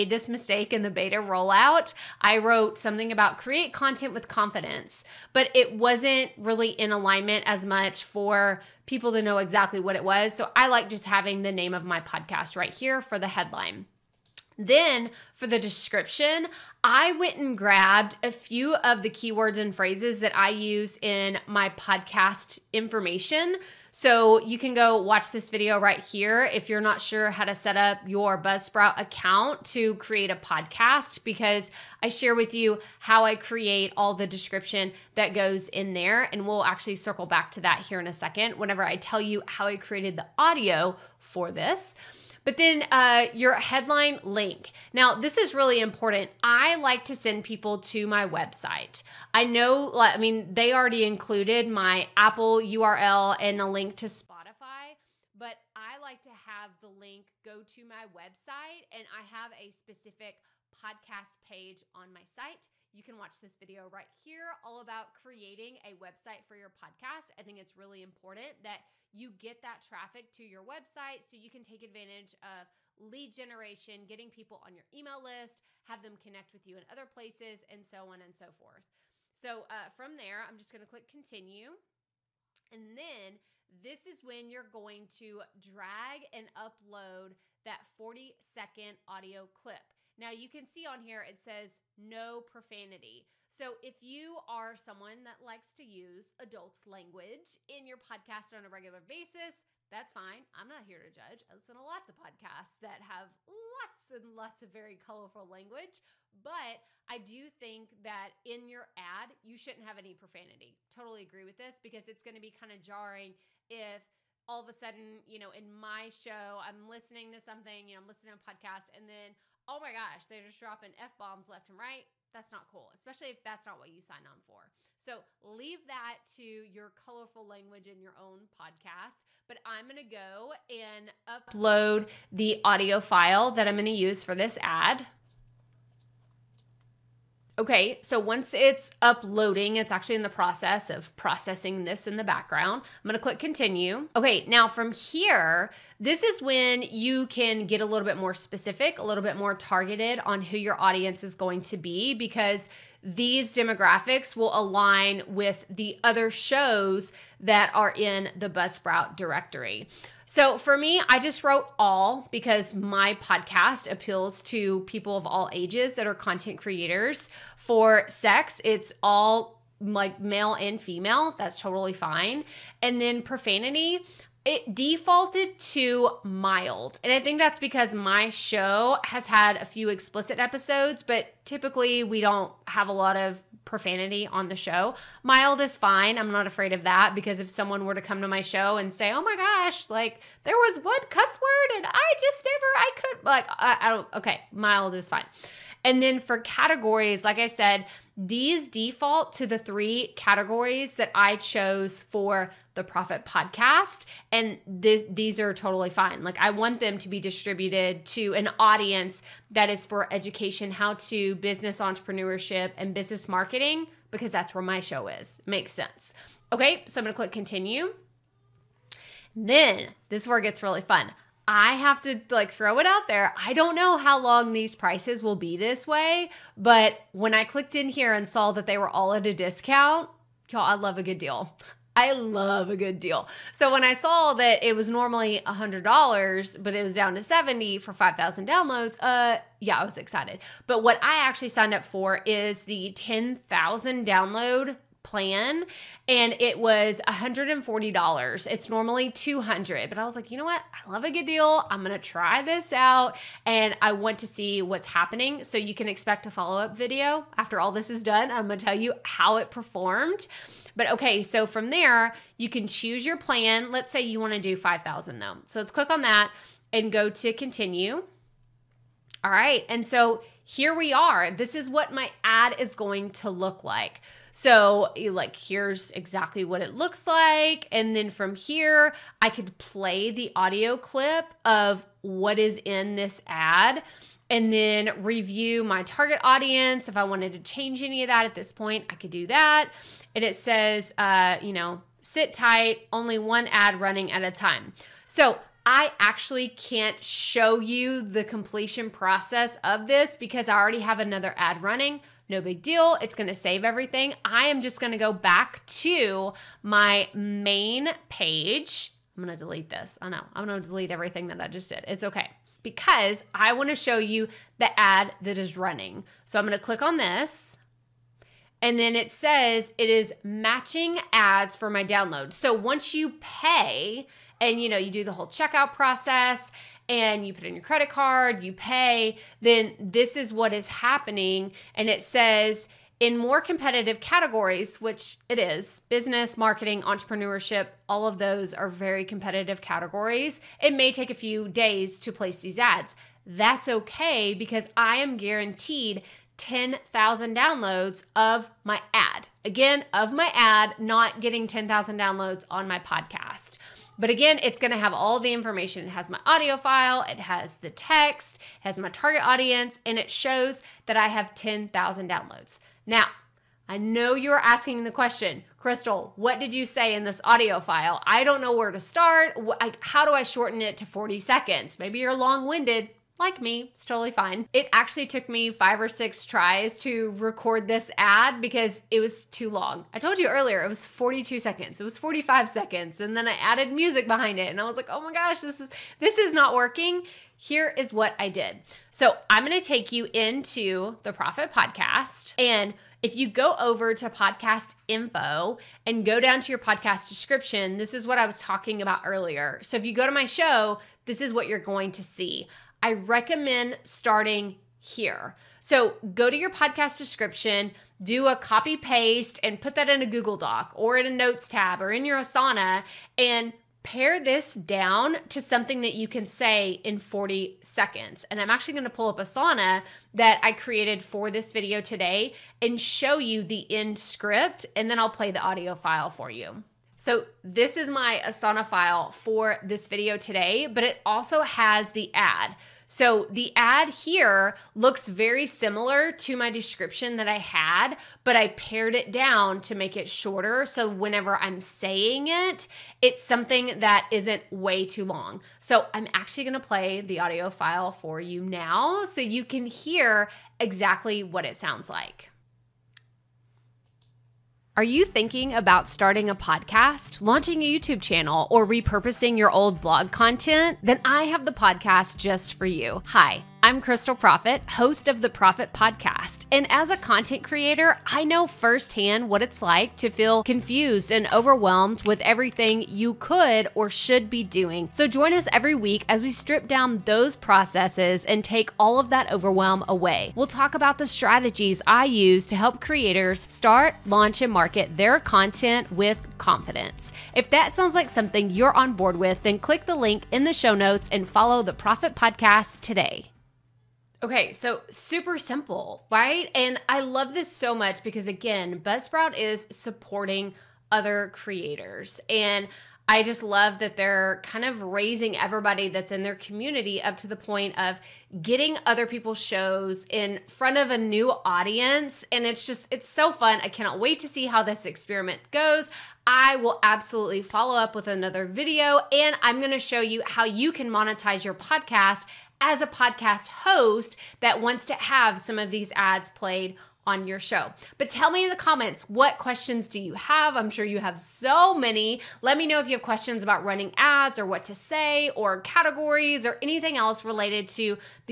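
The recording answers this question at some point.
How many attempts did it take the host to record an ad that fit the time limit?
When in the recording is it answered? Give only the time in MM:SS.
06:15.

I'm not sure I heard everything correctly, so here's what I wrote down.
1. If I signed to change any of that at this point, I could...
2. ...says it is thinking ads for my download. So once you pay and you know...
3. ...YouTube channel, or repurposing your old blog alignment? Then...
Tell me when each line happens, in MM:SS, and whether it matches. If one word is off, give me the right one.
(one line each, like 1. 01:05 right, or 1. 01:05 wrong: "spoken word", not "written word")
1. 04:46 wrong: "wanted", not "signed"
2. 05:19 wrong: "matching", not "thinking"
3. 07:37 wrong: "content", not "alignment".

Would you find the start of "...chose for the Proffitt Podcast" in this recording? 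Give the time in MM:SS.
03:21.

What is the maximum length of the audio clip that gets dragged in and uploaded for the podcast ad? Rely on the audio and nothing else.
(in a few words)
40 seconds.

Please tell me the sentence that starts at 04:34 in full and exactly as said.
So, like, here's exactly what it looks like.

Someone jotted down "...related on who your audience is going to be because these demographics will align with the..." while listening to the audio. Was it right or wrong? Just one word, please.
wrong.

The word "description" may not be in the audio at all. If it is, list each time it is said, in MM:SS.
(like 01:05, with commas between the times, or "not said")
00:15, 00:34, 06:37, 06:46, 07:16.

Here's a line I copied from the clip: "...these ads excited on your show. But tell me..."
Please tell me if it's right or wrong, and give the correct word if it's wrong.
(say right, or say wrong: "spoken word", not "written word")
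wrong: "played", not "excited".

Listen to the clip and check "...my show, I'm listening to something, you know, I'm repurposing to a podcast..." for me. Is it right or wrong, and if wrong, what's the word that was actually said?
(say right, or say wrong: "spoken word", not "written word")
wrong: "listening", not "repurposing".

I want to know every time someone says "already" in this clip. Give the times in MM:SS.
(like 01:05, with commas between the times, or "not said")
00:50, 05:00.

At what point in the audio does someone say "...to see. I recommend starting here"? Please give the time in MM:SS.
06:41.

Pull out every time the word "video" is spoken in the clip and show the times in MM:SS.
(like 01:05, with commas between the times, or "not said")
00:25, 01:03, 04:16, 07:01, 07:09, 08:38.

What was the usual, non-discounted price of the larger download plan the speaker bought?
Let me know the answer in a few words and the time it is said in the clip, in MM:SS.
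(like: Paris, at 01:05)
$200, at 04:09.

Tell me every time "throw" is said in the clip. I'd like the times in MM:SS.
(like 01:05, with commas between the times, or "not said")
03:42.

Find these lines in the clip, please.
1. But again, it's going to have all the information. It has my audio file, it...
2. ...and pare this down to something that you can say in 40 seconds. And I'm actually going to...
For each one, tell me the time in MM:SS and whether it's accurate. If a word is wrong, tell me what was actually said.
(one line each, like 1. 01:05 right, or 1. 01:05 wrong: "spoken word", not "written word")
1. 05:53 right
2. 06:53 right.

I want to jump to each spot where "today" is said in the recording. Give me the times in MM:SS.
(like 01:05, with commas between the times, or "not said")
07:01, 07:10, 08:12.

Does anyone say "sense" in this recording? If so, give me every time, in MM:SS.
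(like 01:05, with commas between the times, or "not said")
03:35.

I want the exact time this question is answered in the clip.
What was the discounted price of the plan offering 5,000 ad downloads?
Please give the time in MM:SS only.
03:57.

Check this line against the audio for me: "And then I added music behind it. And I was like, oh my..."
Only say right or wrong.
right.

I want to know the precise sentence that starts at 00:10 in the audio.
So I like just having the name of my podcast right here for the headline.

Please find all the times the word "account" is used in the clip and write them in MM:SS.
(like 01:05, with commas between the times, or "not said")
00:28.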